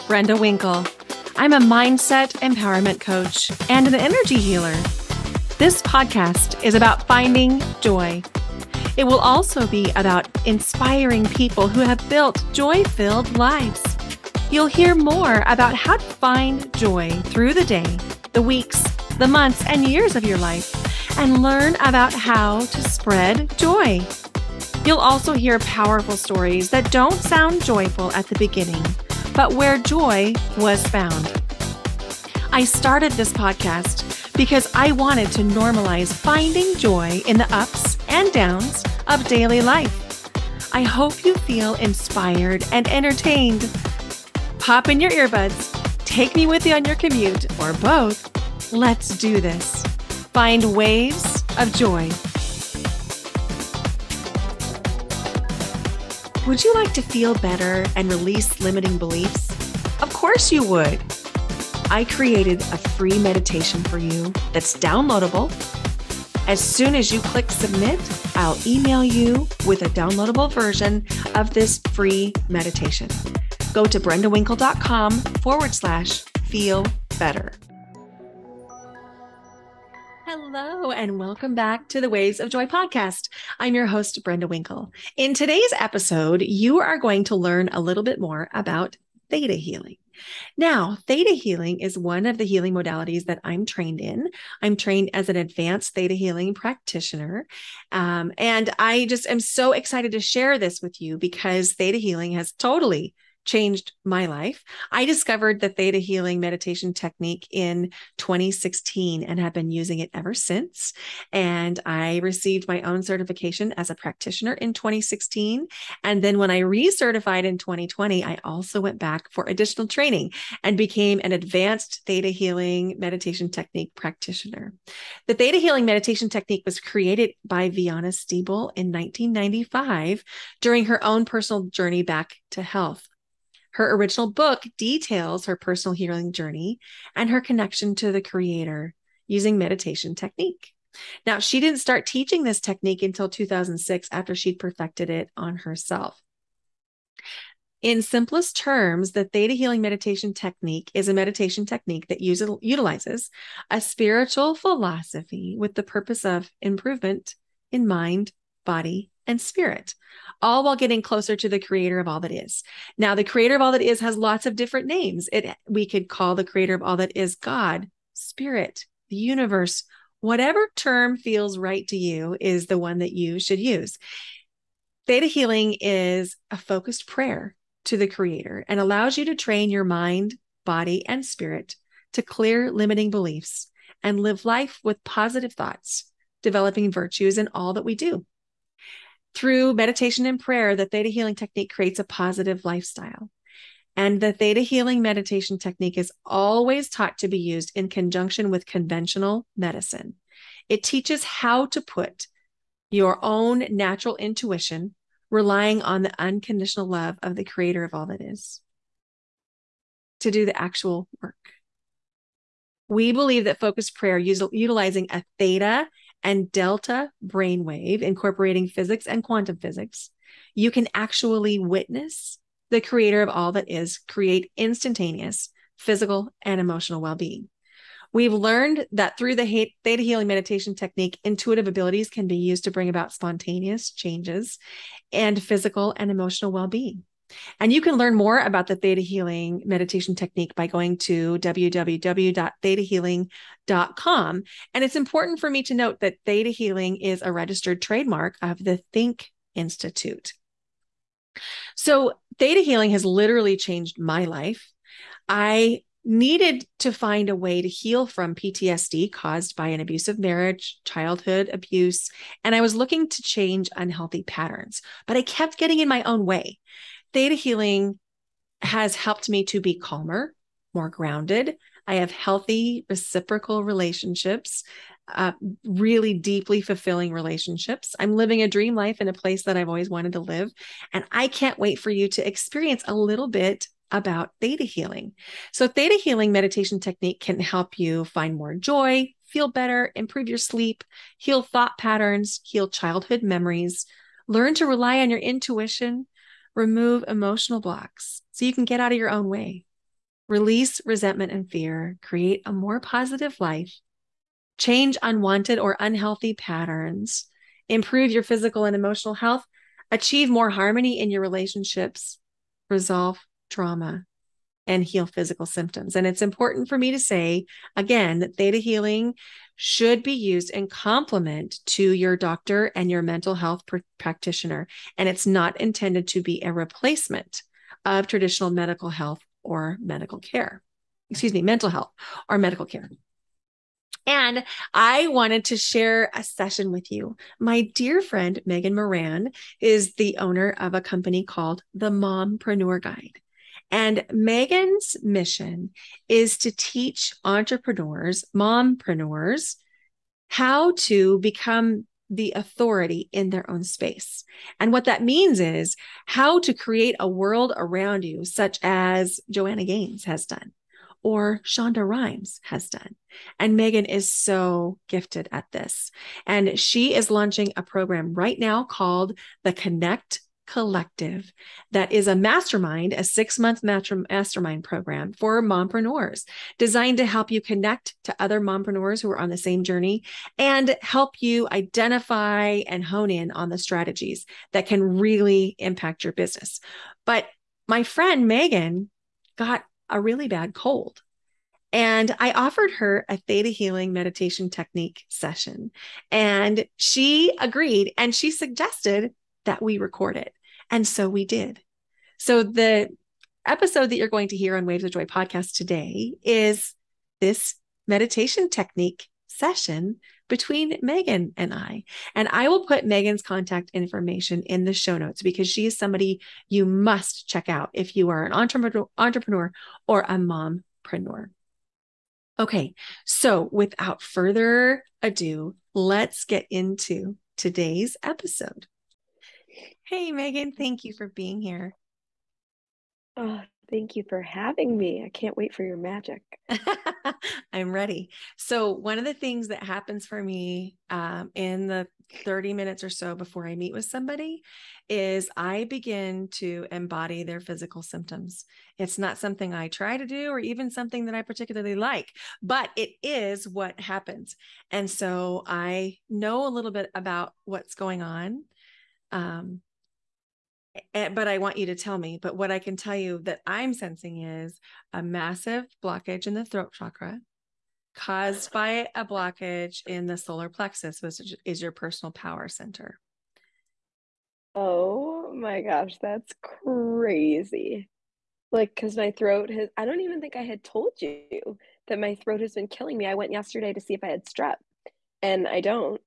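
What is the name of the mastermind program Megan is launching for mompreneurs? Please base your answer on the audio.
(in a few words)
Connect Collective.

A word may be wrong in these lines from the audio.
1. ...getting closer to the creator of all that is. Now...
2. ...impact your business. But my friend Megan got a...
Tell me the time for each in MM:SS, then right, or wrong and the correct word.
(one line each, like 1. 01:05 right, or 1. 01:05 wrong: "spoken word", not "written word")
1. 02:40 right
2. 06:25 right.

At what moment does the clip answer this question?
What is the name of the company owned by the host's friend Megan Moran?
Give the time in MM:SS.
05:41.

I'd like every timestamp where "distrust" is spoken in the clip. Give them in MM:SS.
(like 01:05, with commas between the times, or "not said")
not said.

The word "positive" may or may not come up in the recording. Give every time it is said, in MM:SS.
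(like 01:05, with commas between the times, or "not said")
03:05, 03:12, 05:02.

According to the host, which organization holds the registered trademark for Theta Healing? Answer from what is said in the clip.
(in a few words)
Think Institute.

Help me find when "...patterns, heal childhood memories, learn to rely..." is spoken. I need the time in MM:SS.
04:51.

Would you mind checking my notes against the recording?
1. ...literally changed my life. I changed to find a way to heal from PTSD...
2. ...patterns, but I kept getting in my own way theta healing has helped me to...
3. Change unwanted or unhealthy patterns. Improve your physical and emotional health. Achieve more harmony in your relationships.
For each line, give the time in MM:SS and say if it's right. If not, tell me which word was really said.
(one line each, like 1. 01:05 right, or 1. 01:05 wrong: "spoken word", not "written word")
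1. 04:13 wrong: "needed", not "changed"
2. 04:24 right
3. 05:04 right.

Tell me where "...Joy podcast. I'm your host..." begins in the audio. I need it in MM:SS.
01:22.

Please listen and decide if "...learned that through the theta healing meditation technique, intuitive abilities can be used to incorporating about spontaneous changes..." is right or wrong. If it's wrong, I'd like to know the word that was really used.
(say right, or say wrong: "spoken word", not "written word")
wrong: "bring", not "incorporating".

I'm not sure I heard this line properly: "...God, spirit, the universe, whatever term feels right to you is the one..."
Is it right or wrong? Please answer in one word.
right.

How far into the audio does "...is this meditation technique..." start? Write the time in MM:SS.
06:46.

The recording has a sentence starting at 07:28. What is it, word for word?
It's not something I try to do or even something that I particularly like, but it is what happens.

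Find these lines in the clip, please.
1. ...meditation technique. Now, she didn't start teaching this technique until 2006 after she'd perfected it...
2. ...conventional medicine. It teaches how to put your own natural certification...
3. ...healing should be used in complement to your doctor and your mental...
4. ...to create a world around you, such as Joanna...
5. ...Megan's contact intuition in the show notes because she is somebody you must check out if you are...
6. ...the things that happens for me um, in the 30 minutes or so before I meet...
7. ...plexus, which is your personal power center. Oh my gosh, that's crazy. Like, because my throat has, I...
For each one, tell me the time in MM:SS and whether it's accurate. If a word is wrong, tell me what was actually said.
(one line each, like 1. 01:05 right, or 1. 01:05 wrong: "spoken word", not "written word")
1. 02:19 right
2. 03:18 wrong: "intuition", not "certification"
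3. 05:18 right
4. 05:56 right
5. 06:52 wrong: "information", not "intuition"
6. 07:19 right
7. 07:50 right.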